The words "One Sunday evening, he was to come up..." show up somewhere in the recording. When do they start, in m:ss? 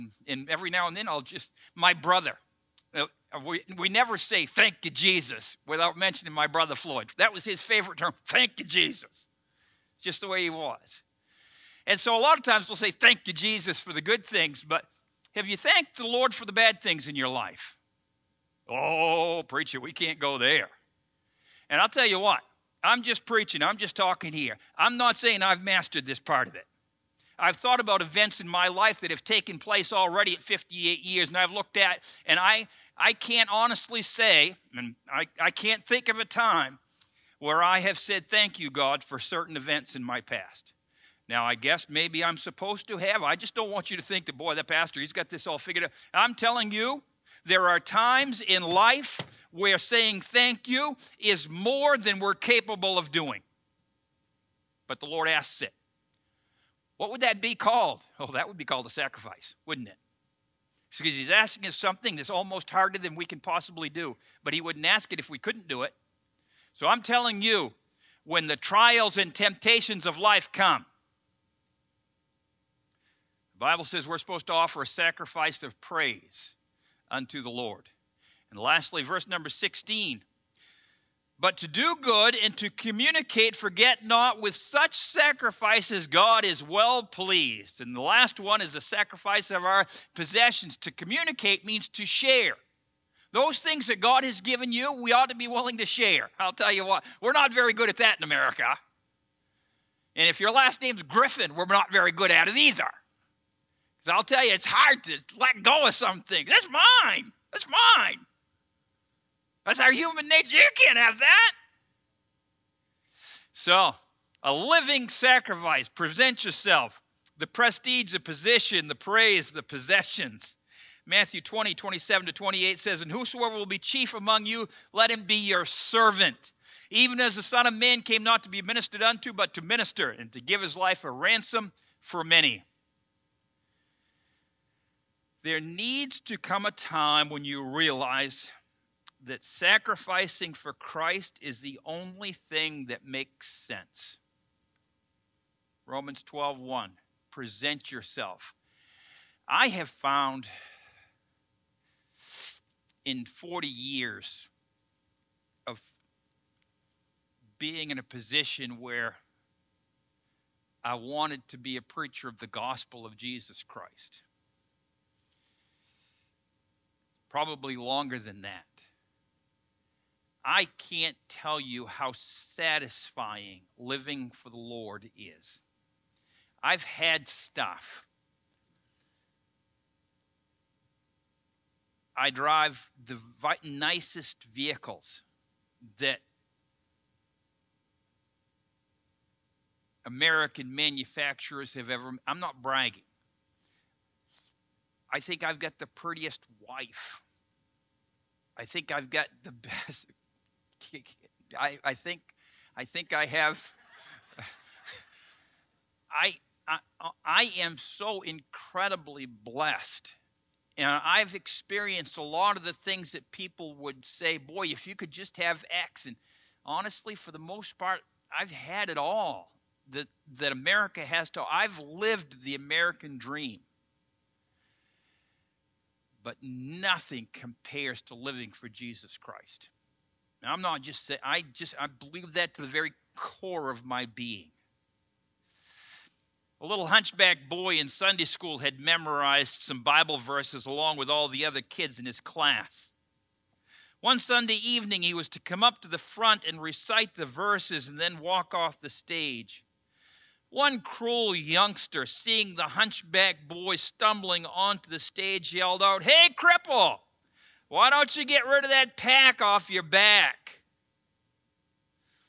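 4:03.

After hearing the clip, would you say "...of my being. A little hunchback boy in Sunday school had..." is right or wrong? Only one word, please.
right.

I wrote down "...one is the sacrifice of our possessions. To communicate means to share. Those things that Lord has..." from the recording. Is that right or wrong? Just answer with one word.
wrong.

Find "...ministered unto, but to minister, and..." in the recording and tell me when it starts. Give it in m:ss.
2:08.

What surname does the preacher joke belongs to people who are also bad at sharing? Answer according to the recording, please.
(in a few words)
Griffin.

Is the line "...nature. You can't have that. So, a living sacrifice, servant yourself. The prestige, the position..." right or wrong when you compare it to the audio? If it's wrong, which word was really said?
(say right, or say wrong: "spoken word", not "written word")
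wrong: "present", not "servant".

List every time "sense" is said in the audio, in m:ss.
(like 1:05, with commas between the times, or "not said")
2:23.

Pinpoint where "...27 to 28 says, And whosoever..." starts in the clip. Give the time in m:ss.
2:01.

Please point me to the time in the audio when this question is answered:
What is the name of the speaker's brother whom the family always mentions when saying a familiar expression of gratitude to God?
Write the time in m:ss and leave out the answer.
0:06.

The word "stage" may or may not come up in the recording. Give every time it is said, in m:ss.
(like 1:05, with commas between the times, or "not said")
4:08, 4:14.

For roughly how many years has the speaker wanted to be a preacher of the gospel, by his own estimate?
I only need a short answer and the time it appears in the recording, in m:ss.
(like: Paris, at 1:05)
40, at 2:33.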